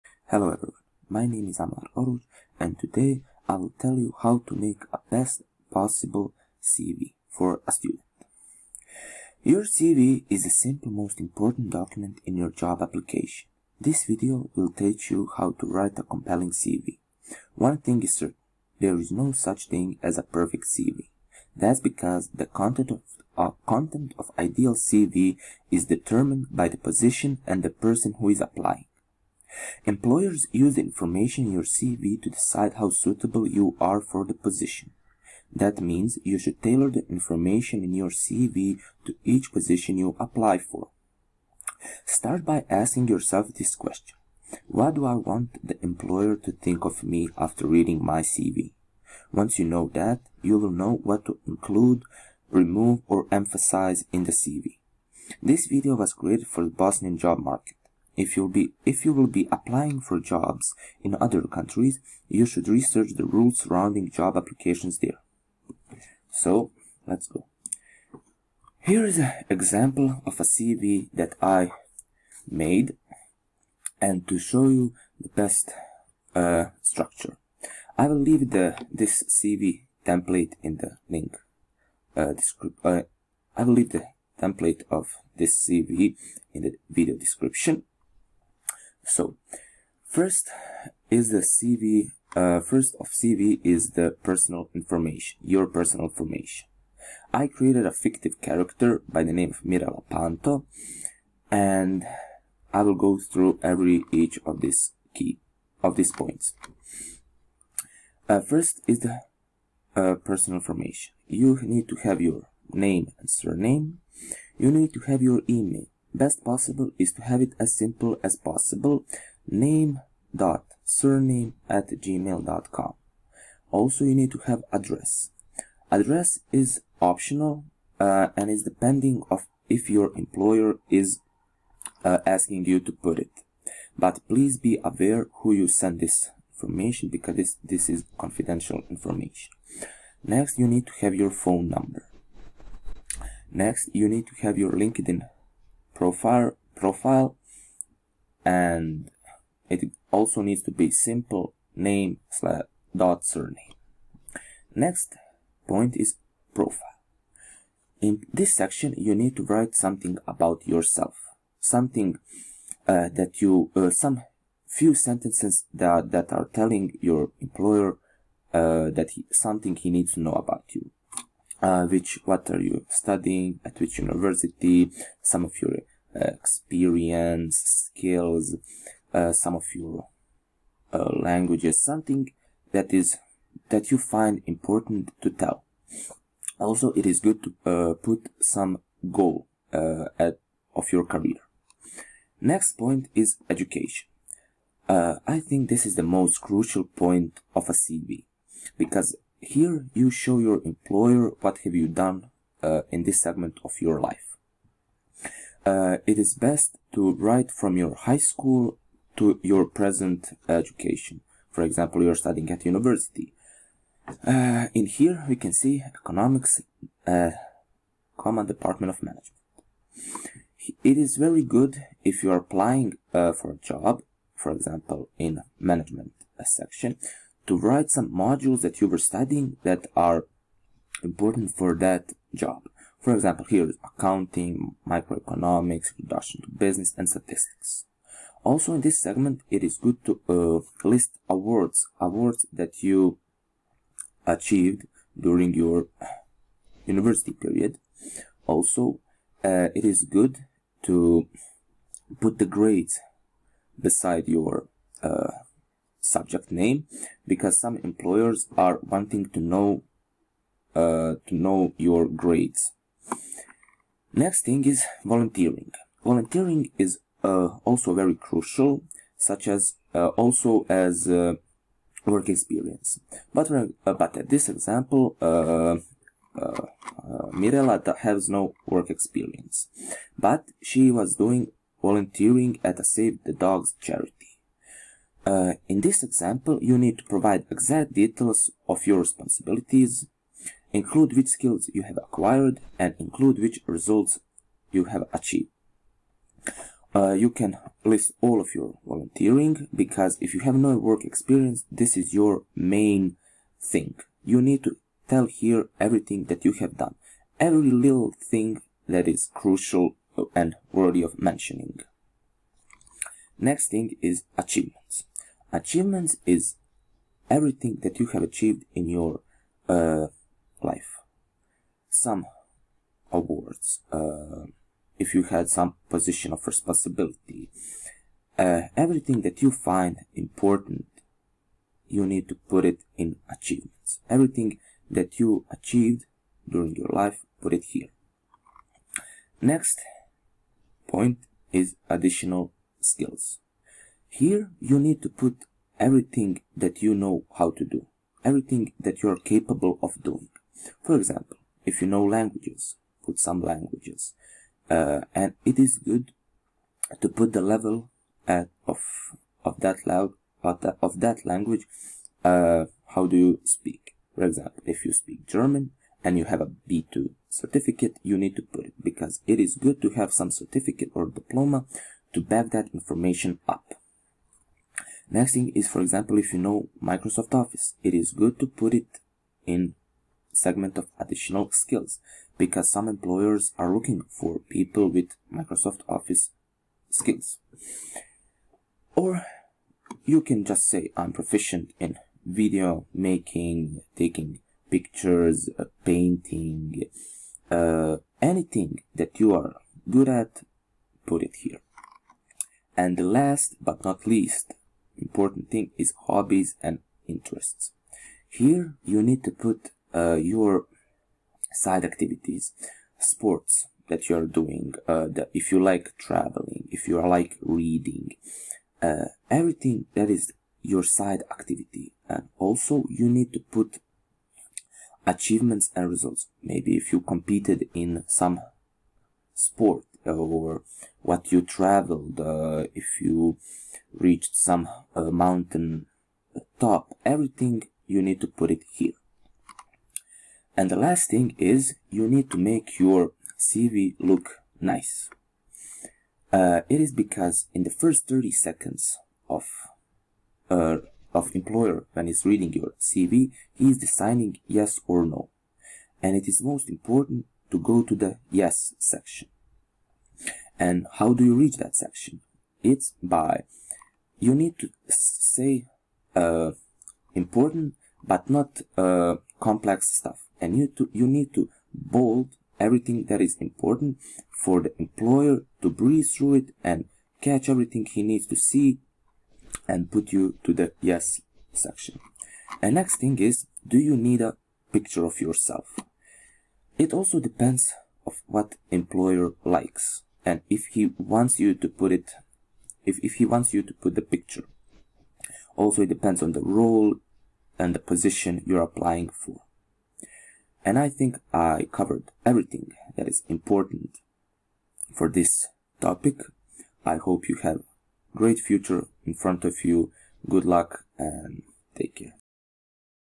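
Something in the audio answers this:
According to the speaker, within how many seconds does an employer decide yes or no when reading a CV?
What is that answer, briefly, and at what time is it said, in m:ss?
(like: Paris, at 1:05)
30, at 7:28.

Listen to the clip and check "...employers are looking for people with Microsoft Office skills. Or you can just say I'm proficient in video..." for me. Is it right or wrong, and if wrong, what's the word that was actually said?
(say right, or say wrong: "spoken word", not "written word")
right.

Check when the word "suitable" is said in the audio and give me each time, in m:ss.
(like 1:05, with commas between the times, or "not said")
0:32.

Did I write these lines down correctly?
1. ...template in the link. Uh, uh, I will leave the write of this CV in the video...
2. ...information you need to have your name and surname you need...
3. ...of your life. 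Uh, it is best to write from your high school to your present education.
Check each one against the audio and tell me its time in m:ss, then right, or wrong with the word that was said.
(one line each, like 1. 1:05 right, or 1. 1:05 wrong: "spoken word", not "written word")
1. 1:20 wrong: "template", not "write"
2. 1:50 right
3. 3:23 right.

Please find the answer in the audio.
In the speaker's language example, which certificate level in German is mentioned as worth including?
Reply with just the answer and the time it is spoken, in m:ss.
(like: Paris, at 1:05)
B2, at 6:06.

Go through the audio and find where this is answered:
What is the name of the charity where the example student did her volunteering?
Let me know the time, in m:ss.
4:42.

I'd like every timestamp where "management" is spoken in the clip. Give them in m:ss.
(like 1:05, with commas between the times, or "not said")
3:39, 3:45.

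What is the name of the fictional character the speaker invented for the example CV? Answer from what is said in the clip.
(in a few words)
Mira Lapanto.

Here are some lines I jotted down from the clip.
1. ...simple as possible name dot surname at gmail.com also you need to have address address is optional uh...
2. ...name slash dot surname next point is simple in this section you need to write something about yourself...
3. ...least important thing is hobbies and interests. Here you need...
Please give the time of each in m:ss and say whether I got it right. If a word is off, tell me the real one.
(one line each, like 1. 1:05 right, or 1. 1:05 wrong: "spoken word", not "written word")
1. 1:57 right
2. 2:31 wrong: "profile", not "simple"
3. 6:44 right.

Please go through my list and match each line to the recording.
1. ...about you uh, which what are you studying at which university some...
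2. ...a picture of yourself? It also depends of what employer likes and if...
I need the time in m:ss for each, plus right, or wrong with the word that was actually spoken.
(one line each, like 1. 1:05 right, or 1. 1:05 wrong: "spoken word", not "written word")
1. 2:50 right
2. 8:04 right.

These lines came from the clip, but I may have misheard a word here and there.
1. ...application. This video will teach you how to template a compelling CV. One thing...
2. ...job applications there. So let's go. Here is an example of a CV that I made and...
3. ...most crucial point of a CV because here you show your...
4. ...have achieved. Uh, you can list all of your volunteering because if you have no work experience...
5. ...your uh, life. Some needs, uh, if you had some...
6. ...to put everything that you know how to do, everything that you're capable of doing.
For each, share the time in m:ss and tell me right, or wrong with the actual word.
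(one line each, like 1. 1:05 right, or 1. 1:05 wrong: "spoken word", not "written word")
1. 0:12 wrong: "write", not "template"
2. 1:04 right
3. 3:16 right
4. 4:54 right
5. 5:18 wrong: "awards", not "needs"
6. 5:45 right.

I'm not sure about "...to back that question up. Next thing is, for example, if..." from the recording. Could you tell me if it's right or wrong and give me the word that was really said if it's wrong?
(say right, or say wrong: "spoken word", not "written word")
wrong: "information", not "question".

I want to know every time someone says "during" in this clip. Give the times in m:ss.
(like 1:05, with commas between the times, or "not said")
4:05, 5:36.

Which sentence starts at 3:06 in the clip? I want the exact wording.
Also, it is good to uh, put some goal at, of your career.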